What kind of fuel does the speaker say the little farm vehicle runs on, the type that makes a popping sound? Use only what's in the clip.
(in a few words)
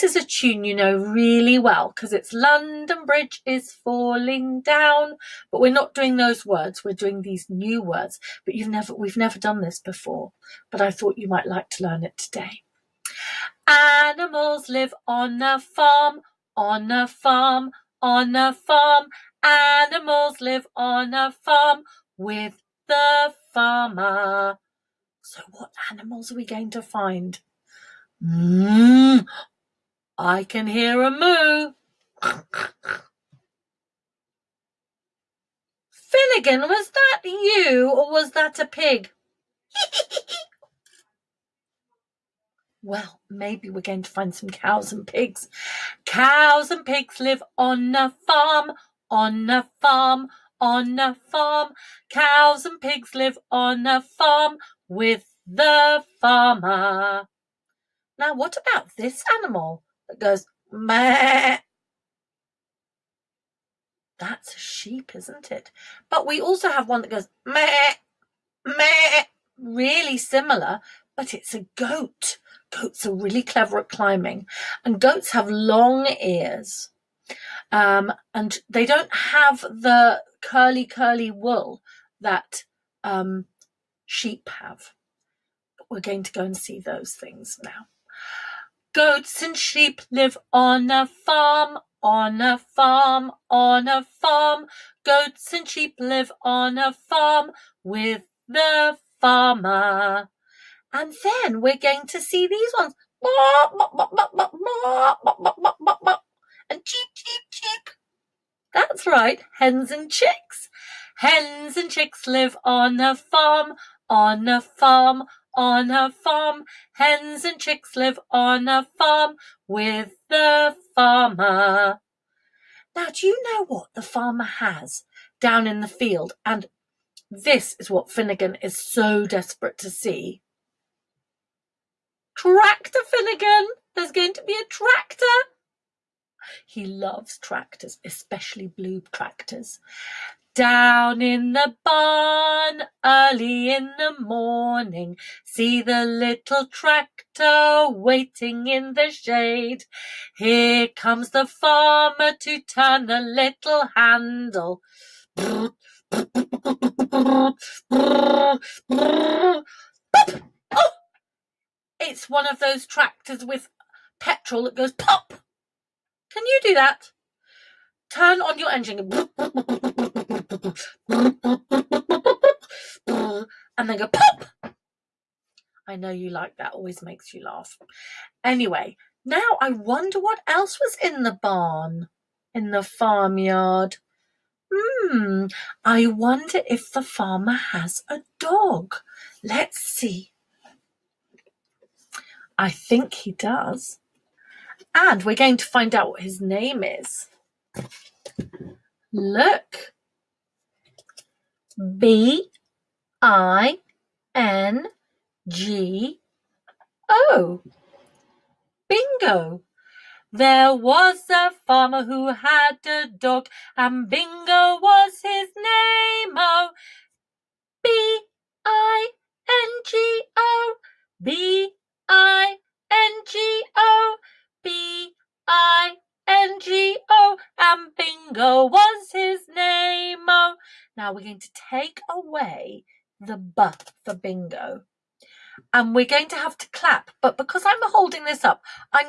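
petrol.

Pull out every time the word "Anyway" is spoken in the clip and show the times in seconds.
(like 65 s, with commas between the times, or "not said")
178 s.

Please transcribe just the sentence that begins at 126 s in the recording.
And this is what Finnegan is so desperate to see.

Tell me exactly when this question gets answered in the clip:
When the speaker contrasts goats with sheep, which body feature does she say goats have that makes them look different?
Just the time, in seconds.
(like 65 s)
75 s.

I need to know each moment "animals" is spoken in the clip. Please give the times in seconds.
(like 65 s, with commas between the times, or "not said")
13 s, 19 s, 25 s, 59 s.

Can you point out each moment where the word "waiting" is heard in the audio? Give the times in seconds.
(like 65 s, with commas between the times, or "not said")
147 s.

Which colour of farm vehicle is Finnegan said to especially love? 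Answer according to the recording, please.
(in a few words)
blue.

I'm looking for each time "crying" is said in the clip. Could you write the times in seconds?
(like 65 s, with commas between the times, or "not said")
not said.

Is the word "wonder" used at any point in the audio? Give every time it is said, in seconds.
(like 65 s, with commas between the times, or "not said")
179 s, 186 s.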